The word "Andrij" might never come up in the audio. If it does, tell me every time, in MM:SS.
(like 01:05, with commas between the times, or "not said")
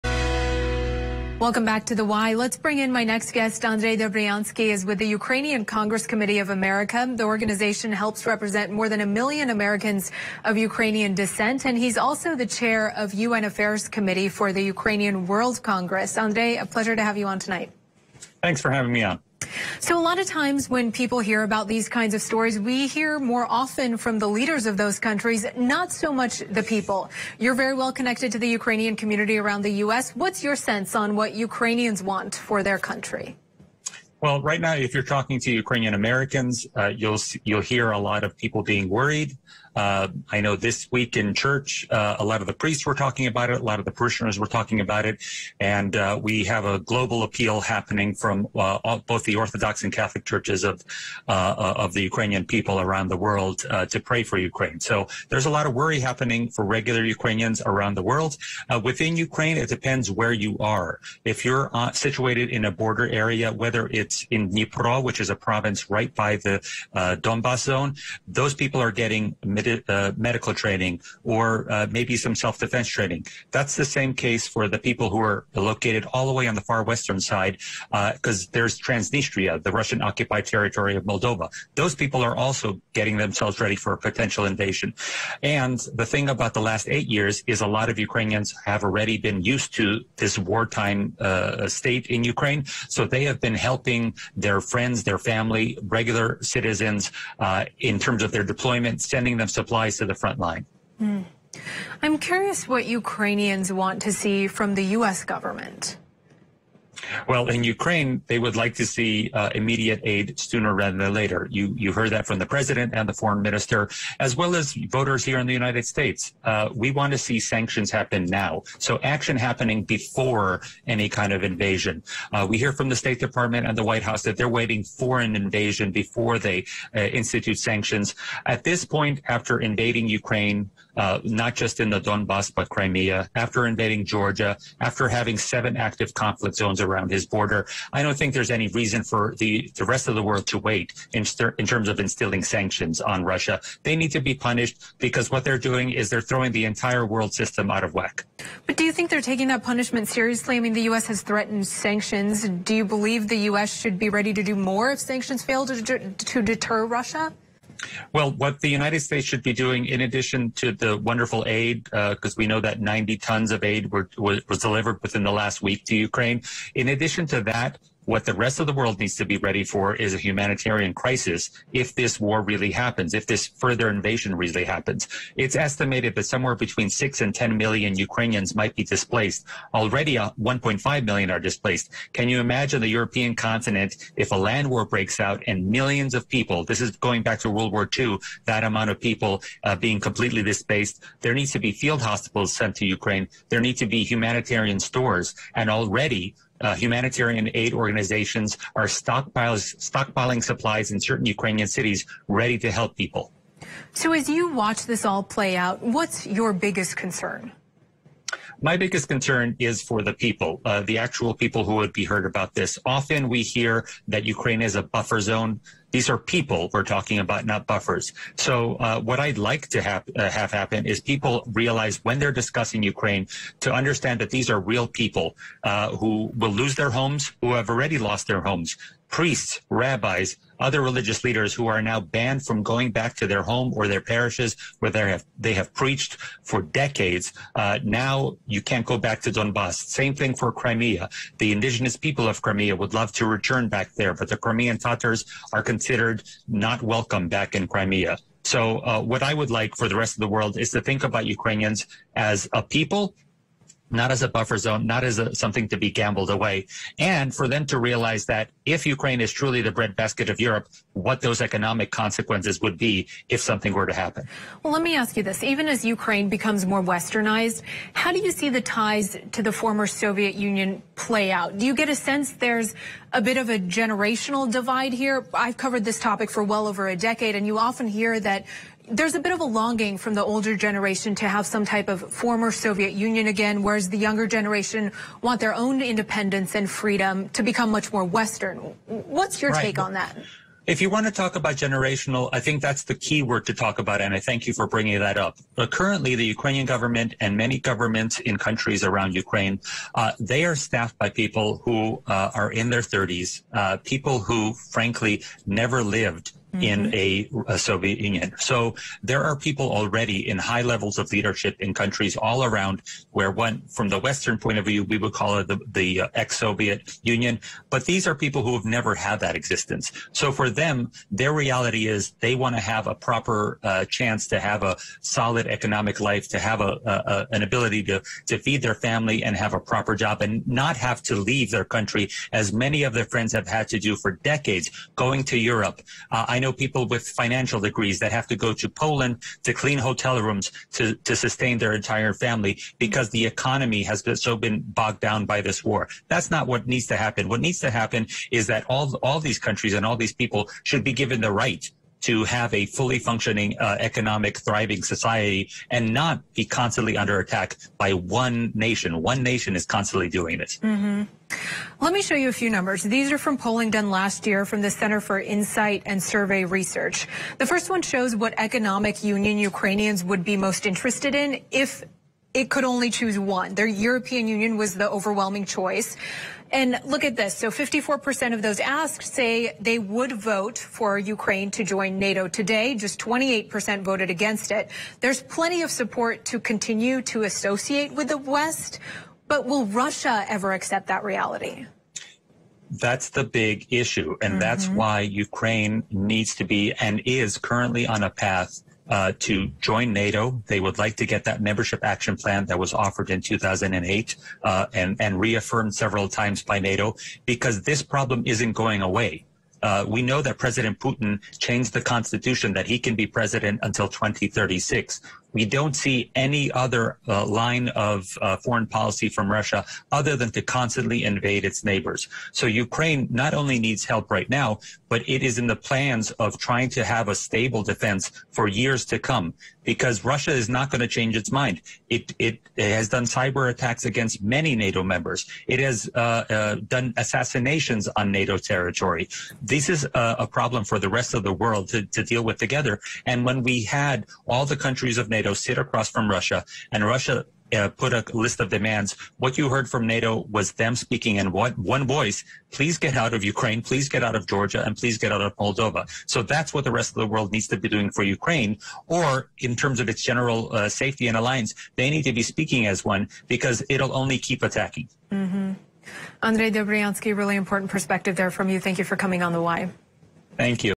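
00:03, 00:16, 07:46.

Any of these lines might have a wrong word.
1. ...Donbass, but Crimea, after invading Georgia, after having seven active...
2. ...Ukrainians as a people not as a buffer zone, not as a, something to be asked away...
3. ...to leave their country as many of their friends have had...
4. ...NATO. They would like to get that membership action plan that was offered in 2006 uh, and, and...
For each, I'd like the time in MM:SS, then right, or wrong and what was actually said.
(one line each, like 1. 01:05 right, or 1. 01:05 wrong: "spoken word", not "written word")
1. 02:12 right
2. 04:11 wrong: "gambled", not "asked"
3. 05:31 right
4. 06:39 wrong: "2008", not "2006".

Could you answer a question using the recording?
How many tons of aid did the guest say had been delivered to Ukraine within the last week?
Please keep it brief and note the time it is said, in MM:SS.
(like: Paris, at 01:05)
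90 tons, at 02:42.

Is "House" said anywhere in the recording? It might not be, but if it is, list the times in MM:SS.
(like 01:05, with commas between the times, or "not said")
02:04.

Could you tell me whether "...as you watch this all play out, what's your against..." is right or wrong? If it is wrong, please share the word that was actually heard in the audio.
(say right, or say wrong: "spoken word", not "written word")
wrong: "biggest", not "against".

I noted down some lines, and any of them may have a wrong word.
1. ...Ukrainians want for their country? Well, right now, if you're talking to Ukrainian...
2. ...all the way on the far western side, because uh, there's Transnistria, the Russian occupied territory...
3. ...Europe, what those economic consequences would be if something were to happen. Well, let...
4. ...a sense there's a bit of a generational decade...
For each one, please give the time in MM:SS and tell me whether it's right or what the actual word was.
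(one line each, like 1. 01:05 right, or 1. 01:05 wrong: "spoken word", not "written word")
1. 00:31 right
2. 01:16 right
3. 04:20 right
4. 04:31 wrong: "divide", not "decade".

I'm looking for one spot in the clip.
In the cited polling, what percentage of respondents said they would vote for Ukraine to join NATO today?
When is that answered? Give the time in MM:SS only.
06:17.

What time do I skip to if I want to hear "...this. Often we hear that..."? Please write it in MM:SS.
03:32.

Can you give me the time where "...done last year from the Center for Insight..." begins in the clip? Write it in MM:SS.
06:03.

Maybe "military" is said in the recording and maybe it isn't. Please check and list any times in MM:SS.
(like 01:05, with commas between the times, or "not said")
not said.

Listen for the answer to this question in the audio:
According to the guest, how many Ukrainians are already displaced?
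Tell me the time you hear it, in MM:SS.
03:00.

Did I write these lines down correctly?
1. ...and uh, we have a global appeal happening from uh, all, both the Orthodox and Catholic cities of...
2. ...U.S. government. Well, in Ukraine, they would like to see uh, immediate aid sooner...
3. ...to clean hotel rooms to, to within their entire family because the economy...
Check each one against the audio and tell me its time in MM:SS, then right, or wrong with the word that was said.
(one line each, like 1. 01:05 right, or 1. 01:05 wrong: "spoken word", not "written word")
1. 00:45 wrong: "churches", not "cities"
2. 01:44 right
3. 05:39 wrong: "sustain", not "within".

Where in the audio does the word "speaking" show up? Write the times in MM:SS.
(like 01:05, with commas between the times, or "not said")
07:30, 07:42.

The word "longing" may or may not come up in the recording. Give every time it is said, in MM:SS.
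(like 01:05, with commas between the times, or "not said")
04:39.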